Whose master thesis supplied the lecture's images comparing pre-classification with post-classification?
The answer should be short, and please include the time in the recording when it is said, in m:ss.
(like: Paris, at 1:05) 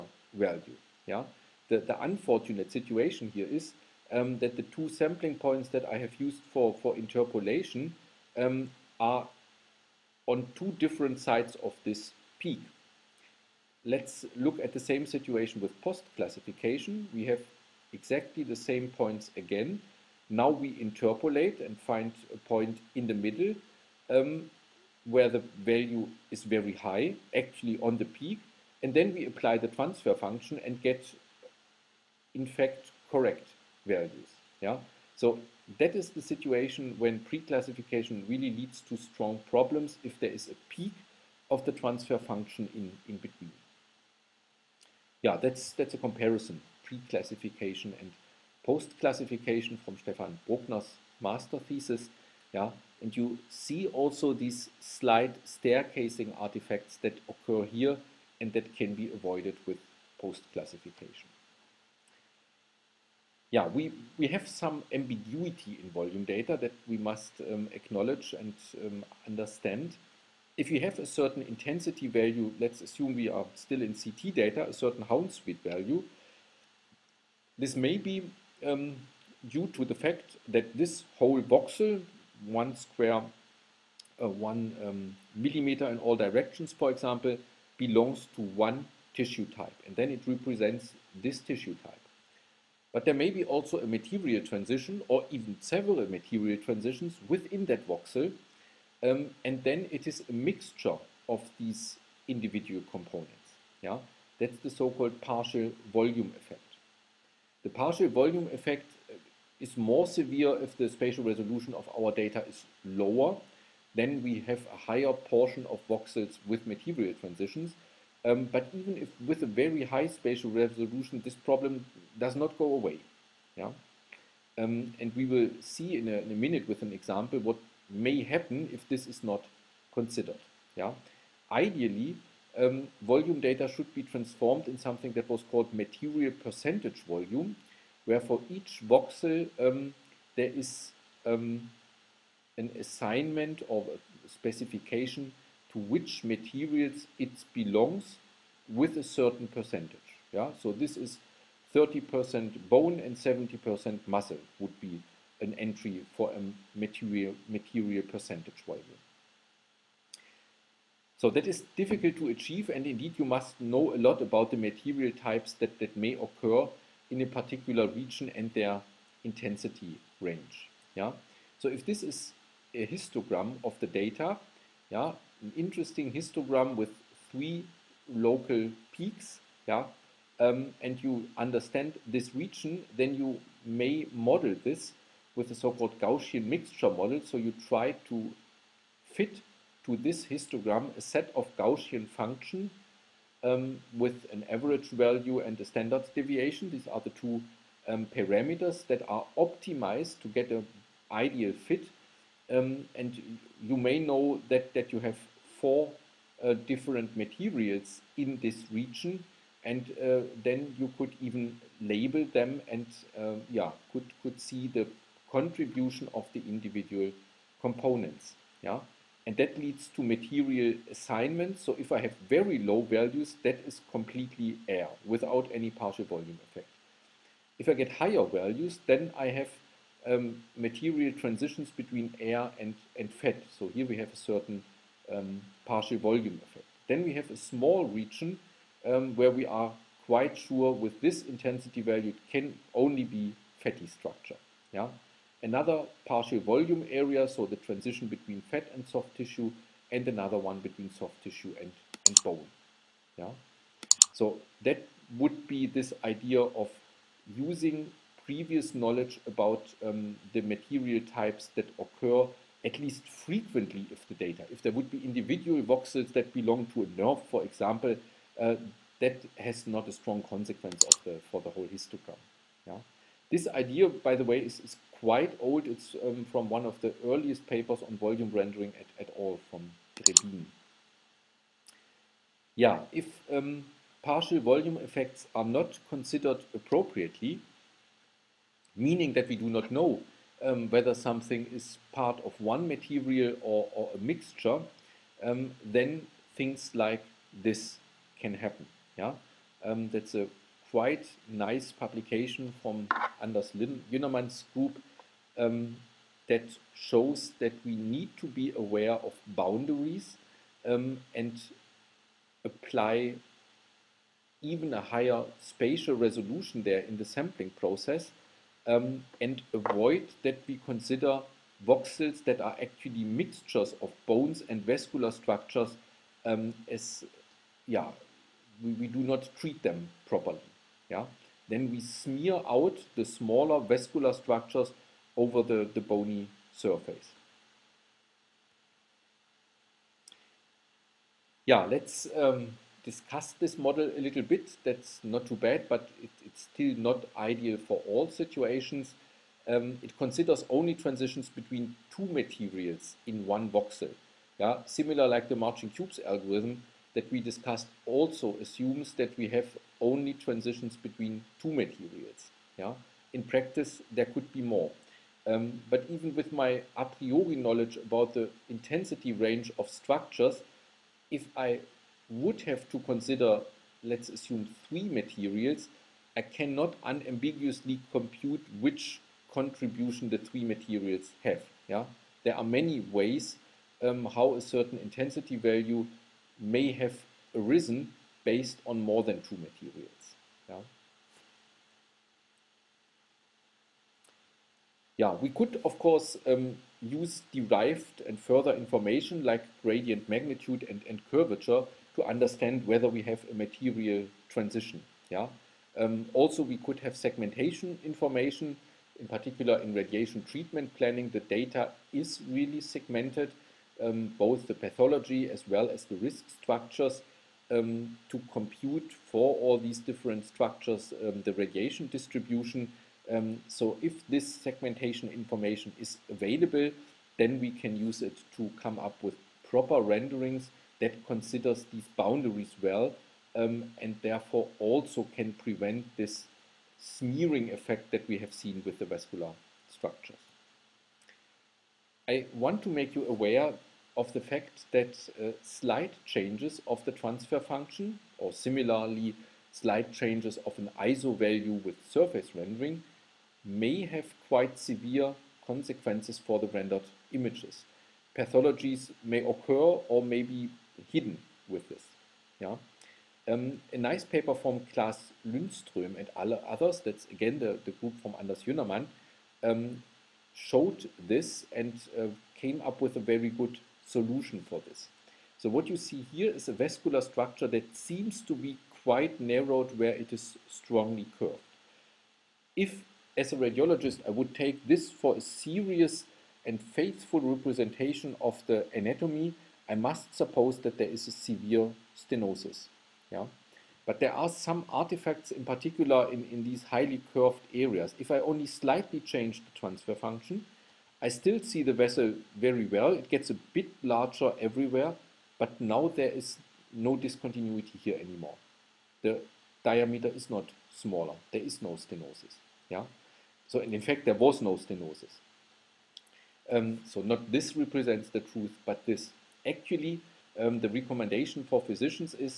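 Stefan Bruckner, at 0:49.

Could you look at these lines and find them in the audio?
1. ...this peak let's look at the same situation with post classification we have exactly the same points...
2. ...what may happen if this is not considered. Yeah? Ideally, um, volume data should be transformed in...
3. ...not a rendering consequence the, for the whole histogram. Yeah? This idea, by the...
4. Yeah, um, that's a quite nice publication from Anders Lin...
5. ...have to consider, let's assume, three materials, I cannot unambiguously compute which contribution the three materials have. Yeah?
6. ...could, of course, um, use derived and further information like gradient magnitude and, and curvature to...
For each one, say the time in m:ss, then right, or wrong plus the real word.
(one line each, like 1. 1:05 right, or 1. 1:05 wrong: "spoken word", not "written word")
1. 0:11 right
2. 2:07 right
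3. 4:29 wrong: "strong", not "rendering"
4. 4:58 right
5. 6:12 right
6. 6:35 right.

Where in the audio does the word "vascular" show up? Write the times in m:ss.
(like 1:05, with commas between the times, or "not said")
5:24, 5:33, 7:18, 7:56.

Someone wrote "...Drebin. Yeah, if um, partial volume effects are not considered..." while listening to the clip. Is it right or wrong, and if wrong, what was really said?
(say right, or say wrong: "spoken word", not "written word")
right.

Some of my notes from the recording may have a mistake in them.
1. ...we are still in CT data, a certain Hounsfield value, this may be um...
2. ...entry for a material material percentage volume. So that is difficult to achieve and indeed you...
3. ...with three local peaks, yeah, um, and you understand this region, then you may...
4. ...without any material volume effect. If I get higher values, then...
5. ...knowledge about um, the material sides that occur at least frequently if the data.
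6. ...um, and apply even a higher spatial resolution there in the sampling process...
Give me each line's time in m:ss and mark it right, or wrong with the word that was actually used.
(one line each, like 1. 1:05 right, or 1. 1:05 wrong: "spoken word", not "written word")
1. 1:13 right
2. 2:35 right
3. 2:56 right
4. 3:45 wrong: "partial", not "material"
5. 4:18 wrong: "types", not "sides"
6. 5:10 right.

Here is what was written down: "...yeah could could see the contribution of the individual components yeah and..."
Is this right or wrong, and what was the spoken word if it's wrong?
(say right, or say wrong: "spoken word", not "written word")
right.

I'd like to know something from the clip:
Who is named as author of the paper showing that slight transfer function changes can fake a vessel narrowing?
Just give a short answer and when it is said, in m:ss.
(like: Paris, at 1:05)
Claes Lundström, at 7:44.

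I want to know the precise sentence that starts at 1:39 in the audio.
Um, and then it is a mixture of these individual components.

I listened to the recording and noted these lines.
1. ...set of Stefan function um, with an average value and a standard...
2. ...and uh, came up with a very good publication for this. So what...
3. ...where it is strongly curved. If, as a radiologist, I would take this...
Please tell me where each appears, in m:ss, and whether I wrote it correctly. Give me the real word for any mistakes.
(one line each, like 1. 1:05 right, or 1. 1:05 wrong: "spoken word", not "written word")
1. 3:11 wrong: "Gaussian", not "Stefan"
2. 7:51 wrong: "solution", not "publication"
3. 7:59 right.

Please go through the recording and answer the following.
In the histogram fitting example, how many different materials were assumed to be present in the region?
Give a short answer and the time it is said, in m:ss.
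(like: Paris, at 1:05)
4, at 3:25.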